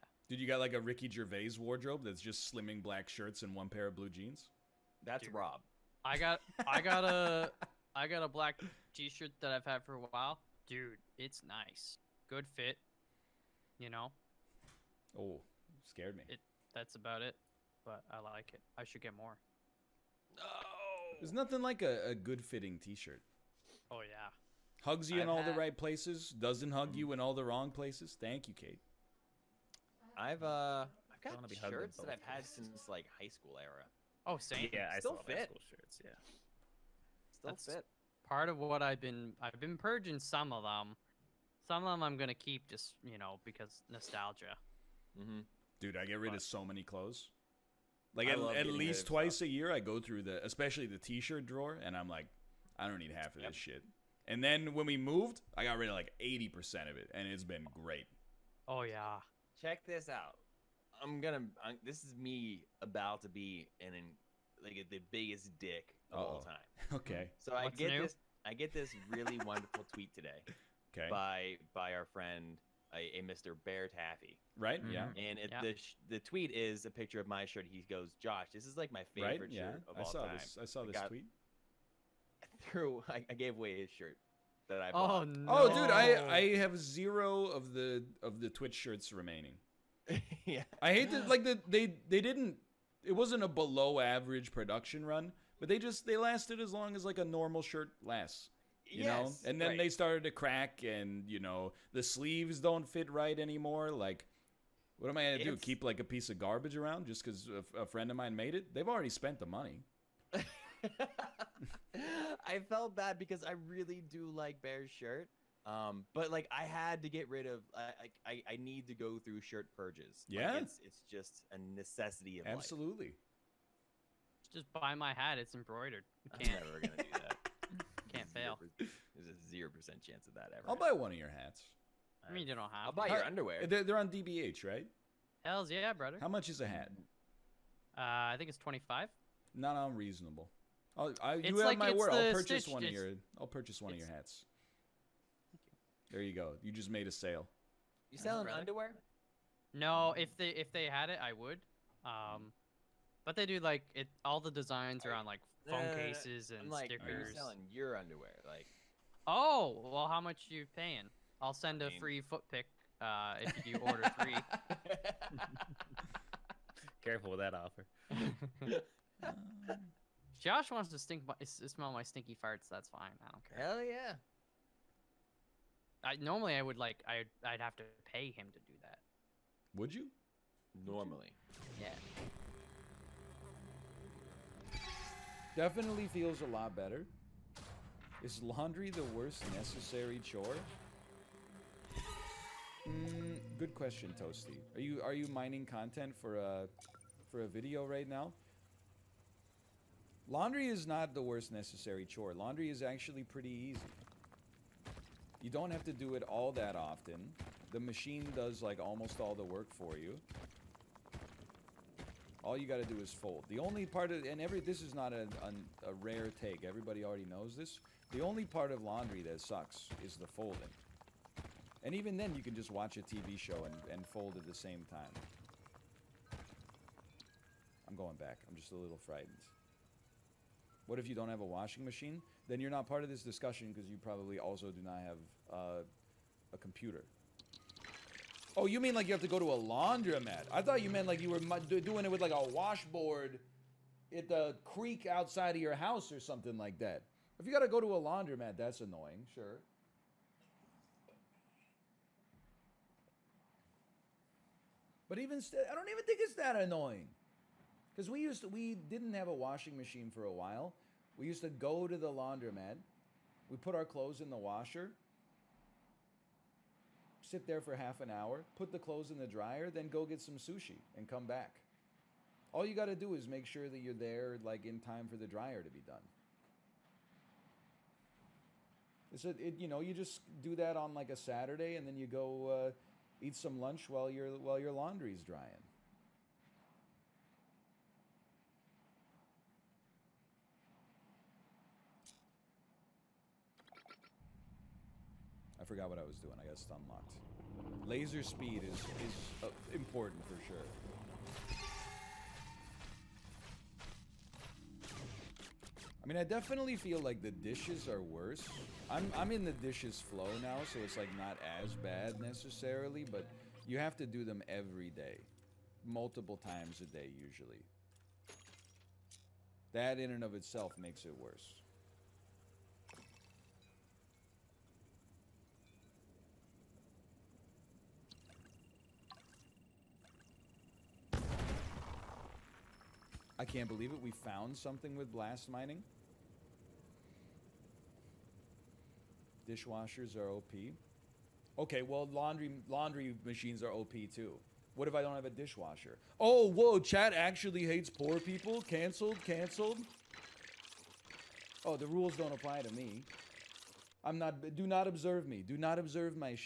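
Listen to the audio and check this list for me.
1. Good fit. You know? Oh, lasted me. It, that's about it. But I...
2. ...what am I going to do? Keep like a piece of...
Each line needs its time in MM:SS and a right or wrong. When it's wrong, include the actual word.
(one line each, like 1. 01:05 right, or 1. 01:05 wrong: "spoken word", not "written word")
1. 00:12 wrong: "scared", not "lasted"
2. 01:45 right.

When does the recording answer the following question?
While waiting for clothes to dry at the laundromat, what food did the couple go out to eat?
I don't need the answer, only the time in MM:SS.
04:30.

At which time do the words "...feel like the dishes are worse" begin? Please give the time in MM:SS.
05:06.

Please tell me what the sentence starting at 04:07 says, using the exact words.
If you got to go to a laundromat, that's annoying, sure.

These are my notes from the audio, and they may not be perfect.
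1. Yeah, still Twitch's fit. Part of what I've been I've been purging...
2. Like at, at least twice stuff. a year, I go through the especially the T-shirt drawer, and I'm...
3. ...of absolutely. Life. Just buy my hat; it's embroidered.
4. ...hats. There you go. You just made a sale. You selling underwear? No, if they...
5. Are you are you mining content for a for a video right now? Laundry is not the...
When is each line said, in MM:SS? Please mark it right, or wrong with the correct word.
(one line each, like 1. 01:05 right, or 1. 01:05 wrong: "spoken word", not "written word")
1. 00:36 wrong: "That", not "Twitch"
2. 00:48 right
3. 02:02 right
4. 02:24 right
5. 03:14 right.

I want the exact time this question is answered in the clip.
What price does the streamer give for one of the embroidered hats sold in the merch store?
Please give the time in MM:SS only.
02:18.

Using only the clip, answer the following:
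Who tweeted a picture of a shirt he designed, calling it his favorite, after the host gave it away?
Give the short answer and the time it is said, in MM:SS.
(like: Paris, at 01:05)
Bear Taffy, at 01:13.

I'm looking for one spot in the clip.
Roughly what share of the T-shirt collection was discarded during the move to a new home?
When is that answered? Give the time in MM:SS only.
00:56.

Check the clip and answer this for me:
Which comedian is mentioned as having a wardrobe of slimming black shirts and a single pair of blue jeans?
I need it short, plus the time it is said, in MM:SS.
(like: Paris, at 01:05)
Ricky Gervais, at 00:00.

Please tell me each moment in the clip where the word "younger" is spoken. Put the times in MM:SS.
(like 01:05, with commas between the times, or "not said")
not said.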